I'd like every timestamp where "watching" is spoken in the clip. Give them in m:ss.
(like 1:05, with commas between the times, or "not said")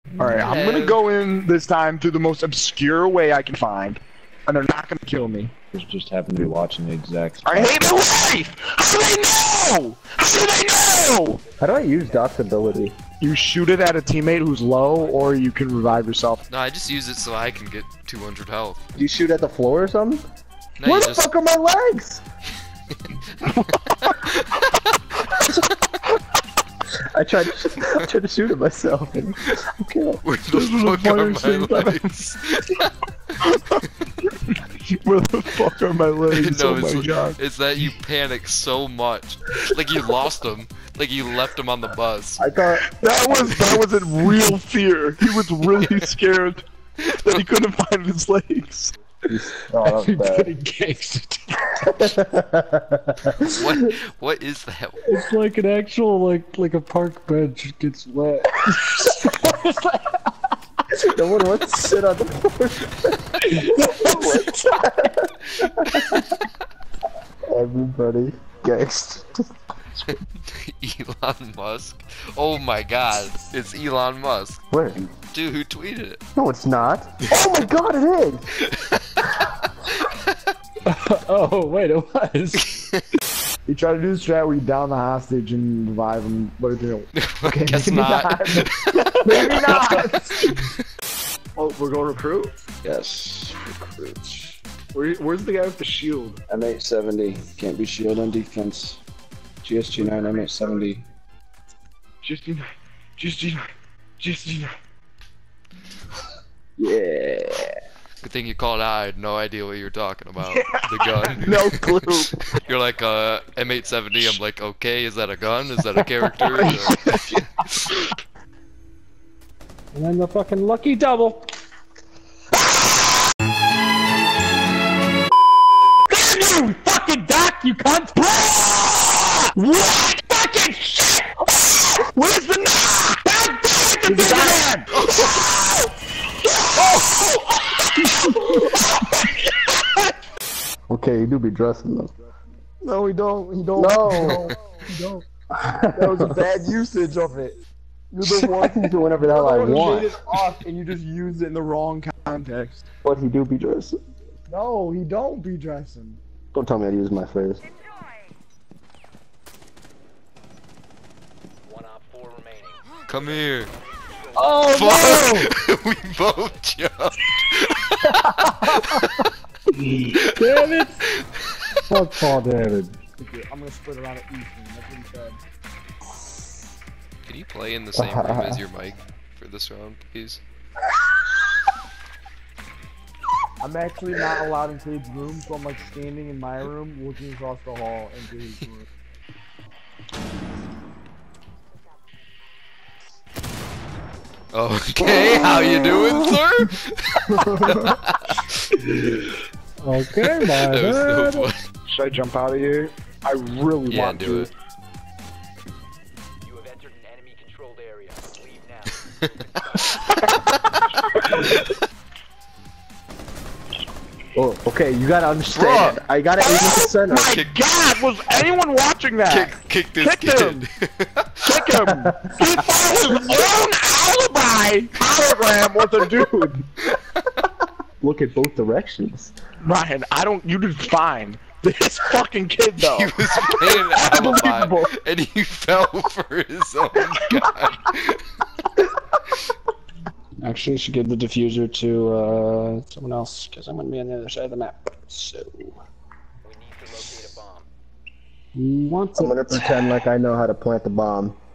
0:06, 3:38.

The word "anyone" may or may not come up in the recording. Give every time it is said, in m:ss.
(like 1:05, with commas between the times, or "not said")
3:38.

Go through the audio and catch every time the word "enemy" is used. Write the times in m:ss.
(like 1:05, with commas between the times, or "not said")
3:27.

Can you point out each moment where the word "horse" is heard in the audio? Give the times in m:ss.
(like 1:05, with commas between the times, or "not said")
not said.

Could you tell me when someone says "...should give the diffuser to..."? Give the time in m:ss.
4:00.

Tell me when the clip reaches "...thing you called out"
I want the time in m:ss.
1:48.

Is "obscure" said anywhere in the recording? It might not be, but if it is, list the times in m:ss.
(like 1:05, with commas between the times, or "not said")
0:02.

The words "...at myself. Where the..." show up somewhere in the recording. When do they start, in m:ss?
0:28.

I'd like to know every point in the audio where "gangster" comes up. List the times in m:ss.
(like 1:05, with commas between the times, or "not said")
0:50, 1:08.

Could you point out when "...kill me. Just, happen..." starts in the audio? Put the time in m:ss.
0:05.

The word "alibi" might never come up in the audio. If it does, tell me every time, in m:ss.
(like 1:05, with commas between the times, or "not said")
3:43, 3:54.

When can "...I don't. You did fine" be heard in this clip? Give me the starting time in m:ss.
3:50.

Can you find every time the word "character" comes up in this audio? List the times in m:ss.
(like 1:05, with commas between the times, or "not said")
1:56.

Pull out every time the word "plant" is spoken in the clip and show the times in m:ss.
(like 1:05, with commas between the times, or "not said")
4:10.